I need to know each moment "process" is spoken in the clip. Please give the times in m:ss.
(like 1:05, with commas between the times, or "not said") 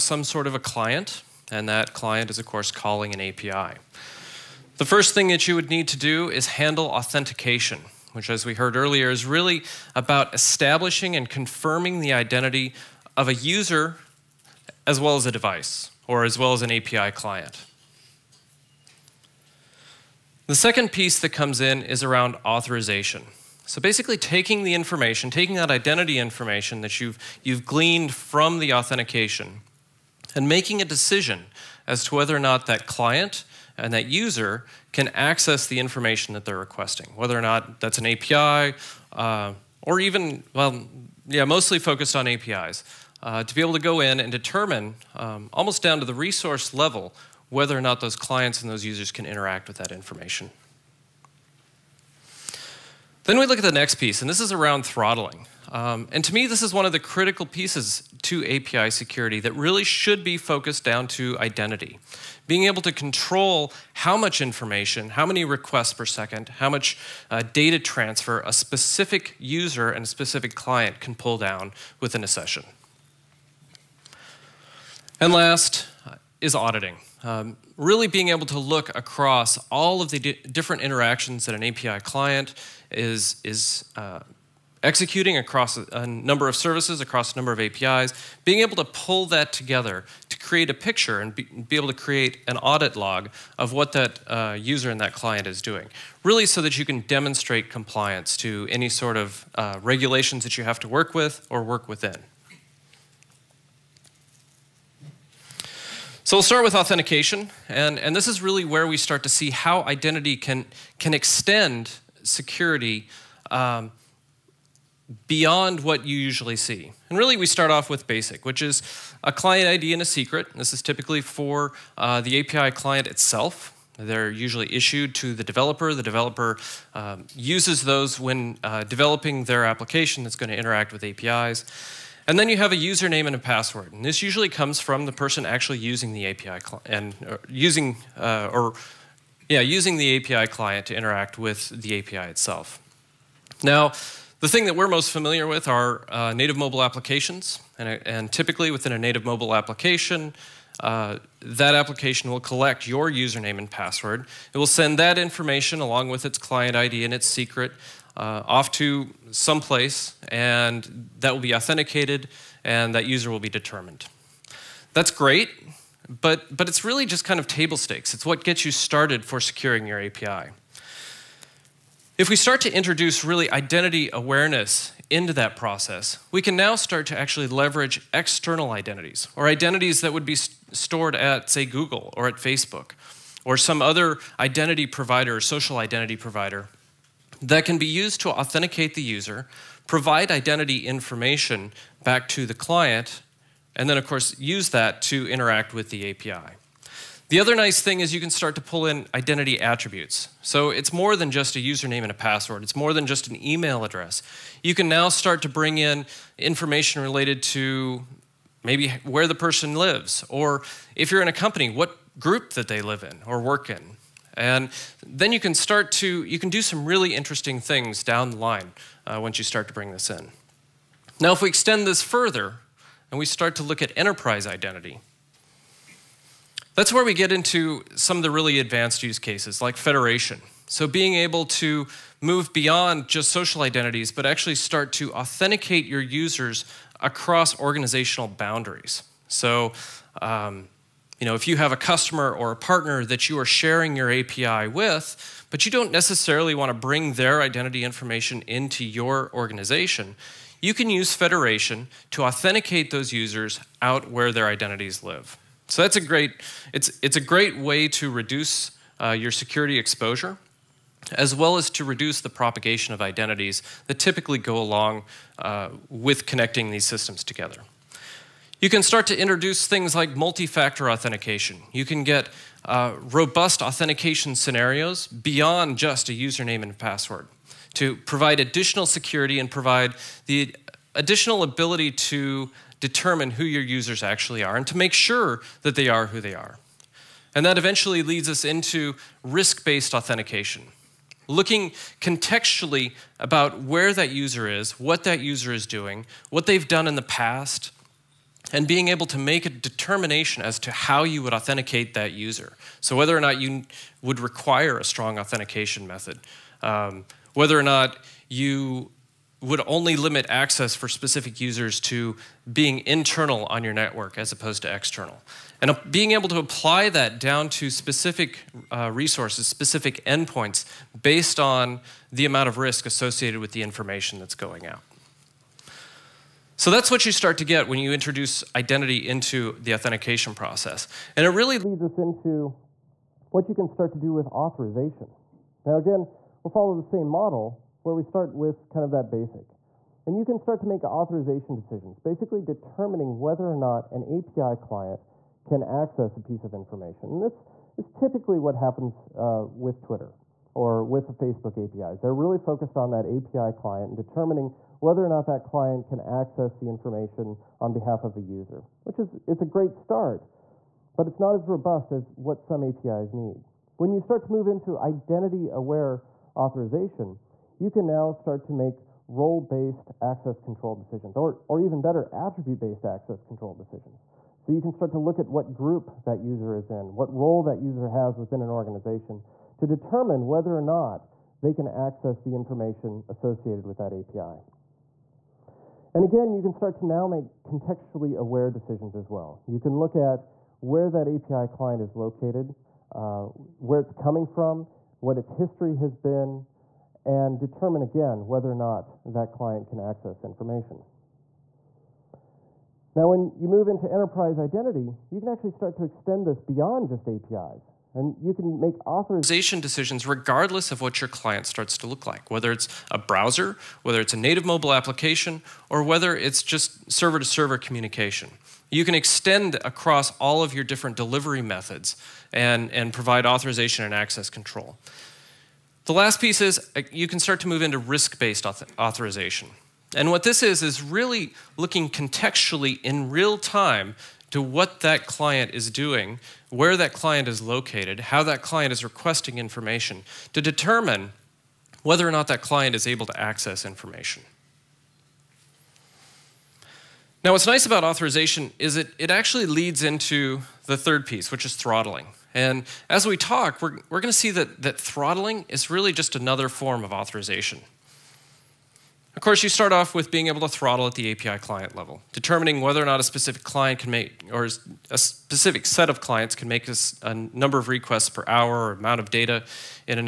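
2:55, 5:30.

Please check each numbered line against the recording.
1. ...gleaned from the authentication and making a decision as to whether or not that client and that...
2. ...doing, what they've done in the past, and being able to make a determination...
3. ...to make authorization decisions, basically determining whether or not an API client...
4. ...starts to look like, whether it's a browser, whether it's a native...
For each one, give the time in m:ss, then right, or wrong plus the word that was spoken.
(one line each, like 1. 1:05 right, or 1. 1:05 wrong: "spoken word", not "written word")
1. 0:27 right
2. 4:55 right
3. 5:40 right
4. 6:51 right.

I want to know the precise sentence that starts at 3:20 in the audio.
So it's more than just a username and a password.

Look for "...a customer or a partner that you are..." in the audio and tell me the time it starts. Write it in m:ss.
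4:01.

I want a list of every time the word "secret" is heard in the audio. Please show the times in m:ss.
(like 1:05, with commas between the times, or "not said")
2:00, 2:37.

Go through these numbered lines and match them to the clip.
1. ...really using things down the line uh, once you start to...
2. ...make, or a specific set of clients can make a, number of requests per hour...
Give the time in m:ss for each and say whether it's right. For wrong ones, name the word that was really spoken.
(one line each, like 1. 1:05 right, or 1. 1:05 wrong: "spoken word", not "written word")
1. 3:36 wrong: "interesting", not "using"
2. 7:43 right.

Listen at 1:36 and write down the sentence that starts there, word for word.
Really so that you can demonstrate compliance to any sort of uh, regulations that you have to work with or work within.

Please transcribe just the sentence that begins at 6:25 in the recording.
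And again, you can start to now make contextually aware decisions as well.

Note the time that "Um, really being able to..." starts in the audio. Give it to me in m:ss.
1:17.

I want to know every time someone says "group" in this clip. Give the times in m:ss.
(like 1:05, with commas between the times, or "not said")
3:32, 6:15.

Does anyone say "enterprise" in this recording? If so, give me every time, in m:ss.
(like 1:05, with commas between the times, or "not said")
3:43, 6:43.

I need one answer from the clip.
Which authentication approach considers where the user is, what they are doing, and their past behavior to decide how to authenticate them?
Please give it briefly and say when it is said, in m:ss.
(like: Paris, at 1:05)
Risk based authentication, at 4:49.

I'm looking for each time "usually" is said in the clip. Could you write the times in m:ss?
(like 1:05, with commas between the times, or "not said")
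1:56, 2:04, 2:14.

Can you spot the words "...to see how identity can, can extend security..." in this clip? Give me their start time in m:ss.
1:49.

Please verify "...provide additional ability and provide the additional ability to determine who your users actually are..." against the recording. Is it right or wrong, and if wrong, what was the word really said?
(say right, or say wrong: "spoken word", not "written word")
wrong: "security", not "ability".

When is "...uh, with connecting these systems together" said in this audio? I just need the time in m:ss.
4:25.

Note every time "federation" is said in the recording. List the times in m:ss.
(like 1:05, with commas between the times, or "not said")
3:49, 4:11.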